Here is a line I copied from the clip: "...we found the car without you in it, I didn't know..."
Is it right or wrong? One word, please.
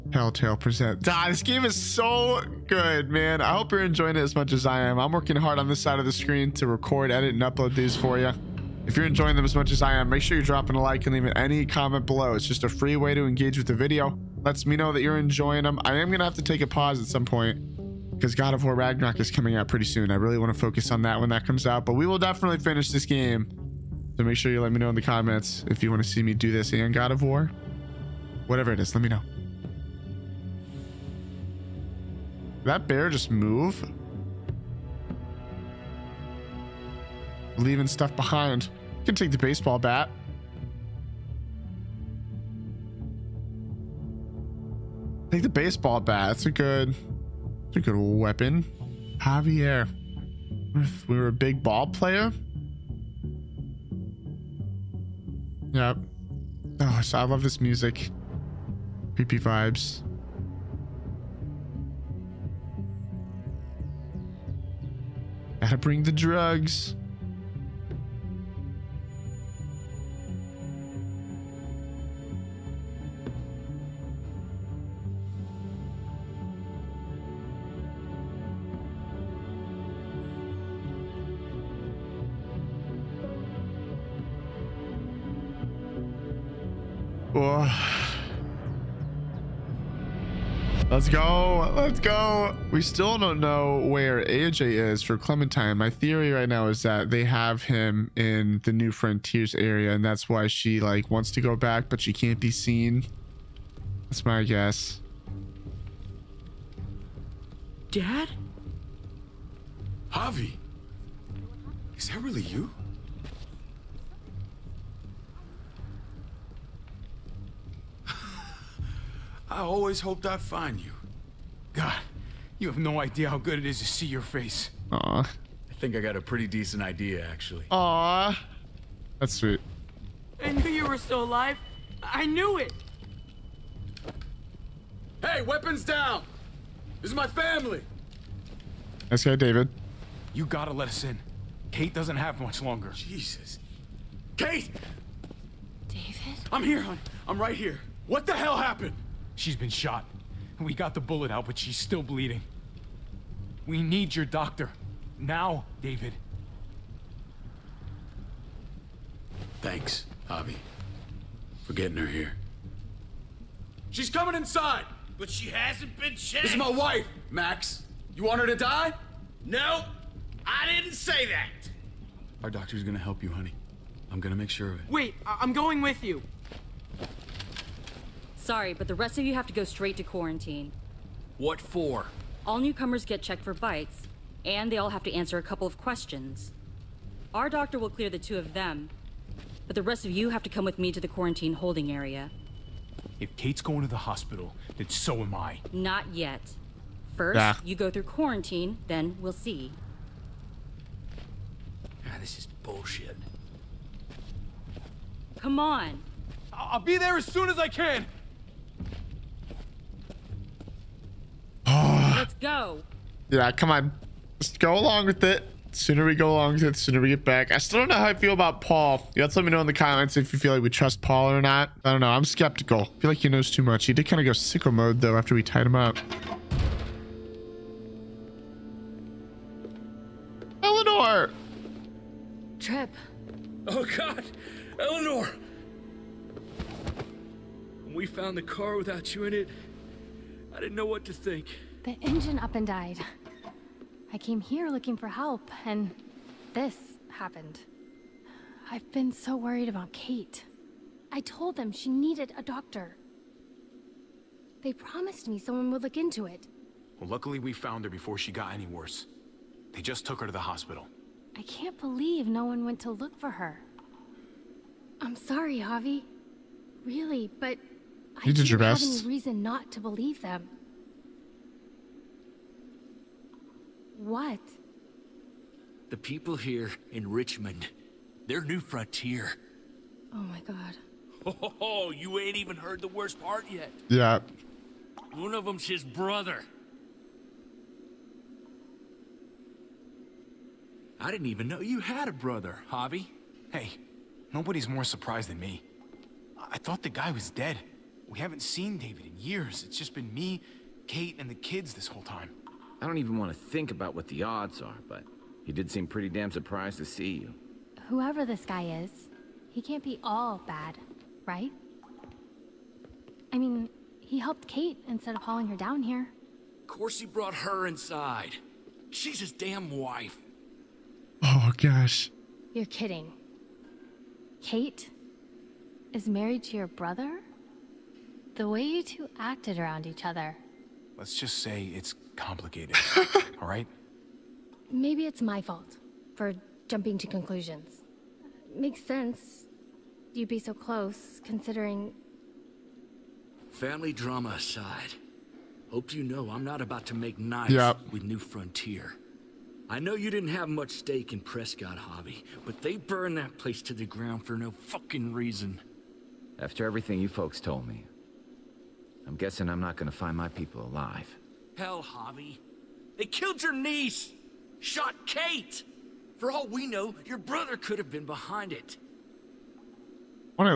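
right.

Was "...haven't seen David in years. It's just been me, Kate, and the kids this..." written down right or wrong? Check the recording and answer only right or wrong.
right.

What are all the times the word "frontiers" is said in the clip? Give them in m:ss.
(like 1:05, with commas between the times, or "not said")
1:38, 4:38, 5:48.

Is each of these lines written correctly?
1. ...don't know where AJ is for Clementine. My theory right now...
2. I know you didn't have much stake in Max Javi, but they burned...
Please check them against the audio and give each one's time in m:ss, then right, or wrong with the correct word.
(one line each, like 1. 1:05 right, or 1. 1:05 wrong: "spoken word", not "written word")
1. 1:33 right
2. 5:49 wrong: "Prescott", not "Max".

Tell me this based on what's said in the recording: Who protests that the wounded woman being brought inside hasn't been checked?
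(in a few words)
Max.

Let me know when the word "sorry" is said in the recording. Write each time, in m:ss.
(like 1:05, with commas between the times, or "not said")
2:58, 4:25.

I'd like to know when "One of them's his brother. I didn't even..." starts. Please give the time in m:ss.
4:45.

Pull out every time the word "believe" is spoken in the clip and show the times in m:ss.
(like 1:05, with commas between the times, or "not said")
4:21, 4:29.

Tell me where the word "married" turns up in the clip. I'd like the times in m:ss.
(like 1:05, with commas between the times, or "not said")
5:26.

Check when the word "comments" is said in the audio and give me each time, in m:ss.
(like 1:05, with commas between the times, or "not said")
0:11, 0:25, 3:39.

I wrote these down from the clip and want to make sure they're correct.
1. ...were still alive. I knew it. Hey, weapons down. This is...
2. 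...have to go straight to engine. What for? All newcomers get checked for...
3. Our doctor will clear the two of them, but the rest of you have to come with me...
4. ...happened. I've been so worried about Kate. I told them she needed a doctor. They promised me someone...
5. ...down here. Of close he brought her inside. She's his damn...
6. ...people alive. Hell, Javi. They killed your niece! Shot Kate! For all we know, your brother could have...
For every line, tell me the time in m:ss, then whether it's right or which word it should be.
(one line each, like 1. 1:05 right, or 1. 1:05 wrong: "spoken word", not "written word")
1. 2:10 right
2. 2:59 wrong: "quarantine", not "engine"
3. 3:07 right
4. 4:07 right
5. 5:15 wrong: "course", not "close"
6. 6:00 right.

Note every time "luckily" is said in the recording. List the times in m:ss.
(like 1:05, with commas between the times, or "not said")
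4:17.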